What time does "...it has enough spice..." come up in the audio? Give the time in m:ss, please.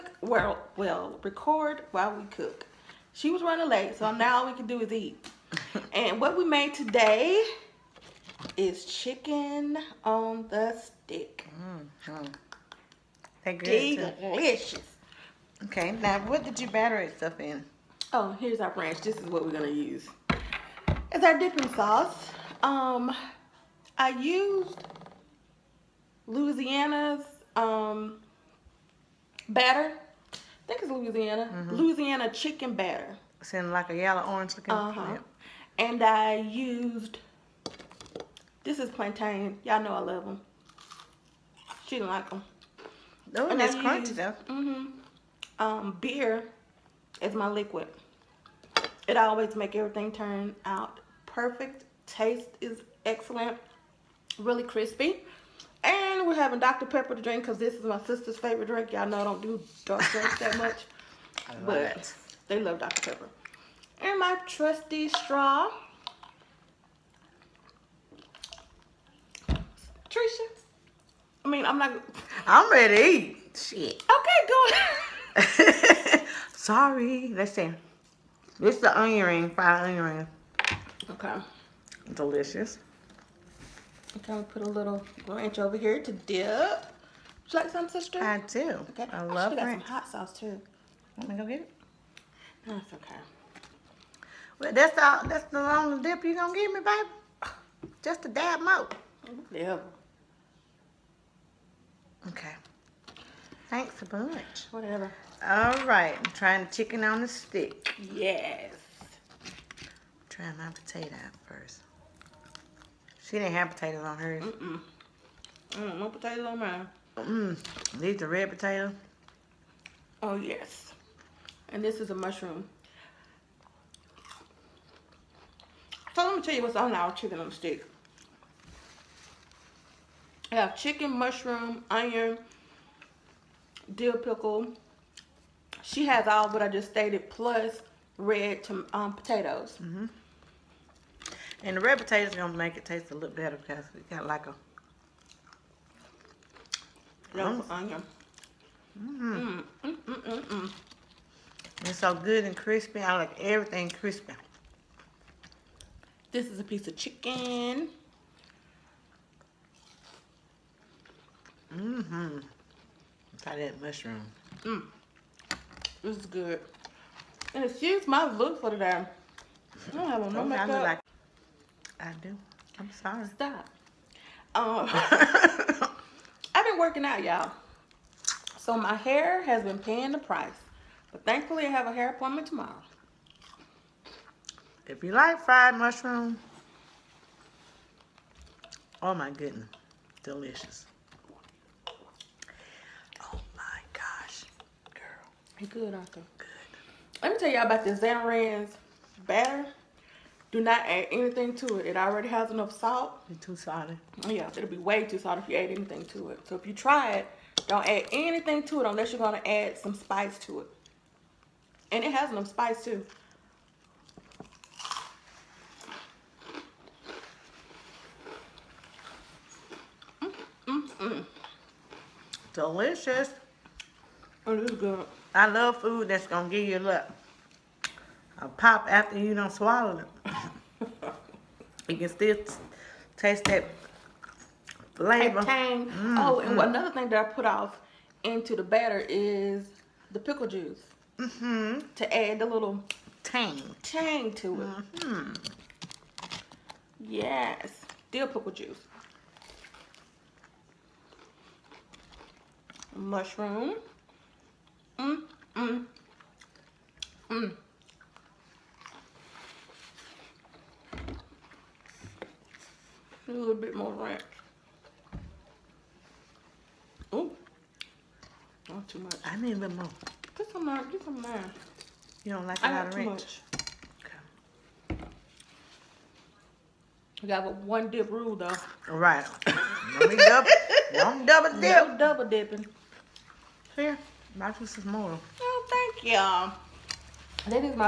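3:32.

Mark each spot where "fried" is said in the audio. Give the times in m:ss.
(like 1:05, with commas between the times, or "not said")
1:19, 3:05.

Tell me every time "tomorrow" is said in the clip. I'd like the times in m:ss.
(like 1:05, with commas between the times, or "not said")
3:02.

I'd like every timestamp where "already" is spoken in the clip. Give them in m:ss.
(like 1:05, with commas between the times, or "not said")
3:21.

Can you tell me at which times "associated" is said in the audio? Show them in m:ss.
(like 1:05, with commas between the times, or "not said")
not said.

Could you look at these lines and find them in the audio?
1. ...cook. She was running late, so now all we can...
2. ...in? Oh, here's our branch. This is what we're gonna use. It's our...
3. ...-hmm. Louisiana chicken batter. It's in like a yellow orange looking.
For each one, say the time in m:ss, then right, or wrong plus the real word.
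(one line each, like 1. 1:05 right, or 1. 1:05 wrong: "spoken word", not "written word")
1. 0:02 right
2. 0:17 right
3. 0:31 right.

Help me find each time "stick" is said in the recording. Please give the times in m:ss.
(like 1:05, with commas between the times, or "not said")
0:10, 1:47, 2:07.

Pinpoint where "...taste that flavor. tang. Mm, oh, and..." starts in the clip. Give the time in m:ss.
3:53.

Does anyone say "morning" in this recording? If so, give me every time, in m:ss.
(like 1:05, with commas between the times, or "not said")
4:44.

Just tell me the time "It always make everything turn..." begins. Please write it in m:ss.
0:49.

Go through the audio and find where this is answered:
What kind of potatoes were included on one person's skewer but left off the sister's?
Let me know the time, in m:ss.
1:58.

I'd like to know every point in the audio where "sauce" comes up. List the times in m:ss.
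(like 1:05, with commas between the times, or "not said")
0:21, 1:30.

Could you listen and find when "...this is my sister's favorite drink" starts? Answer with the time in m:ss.
0:57.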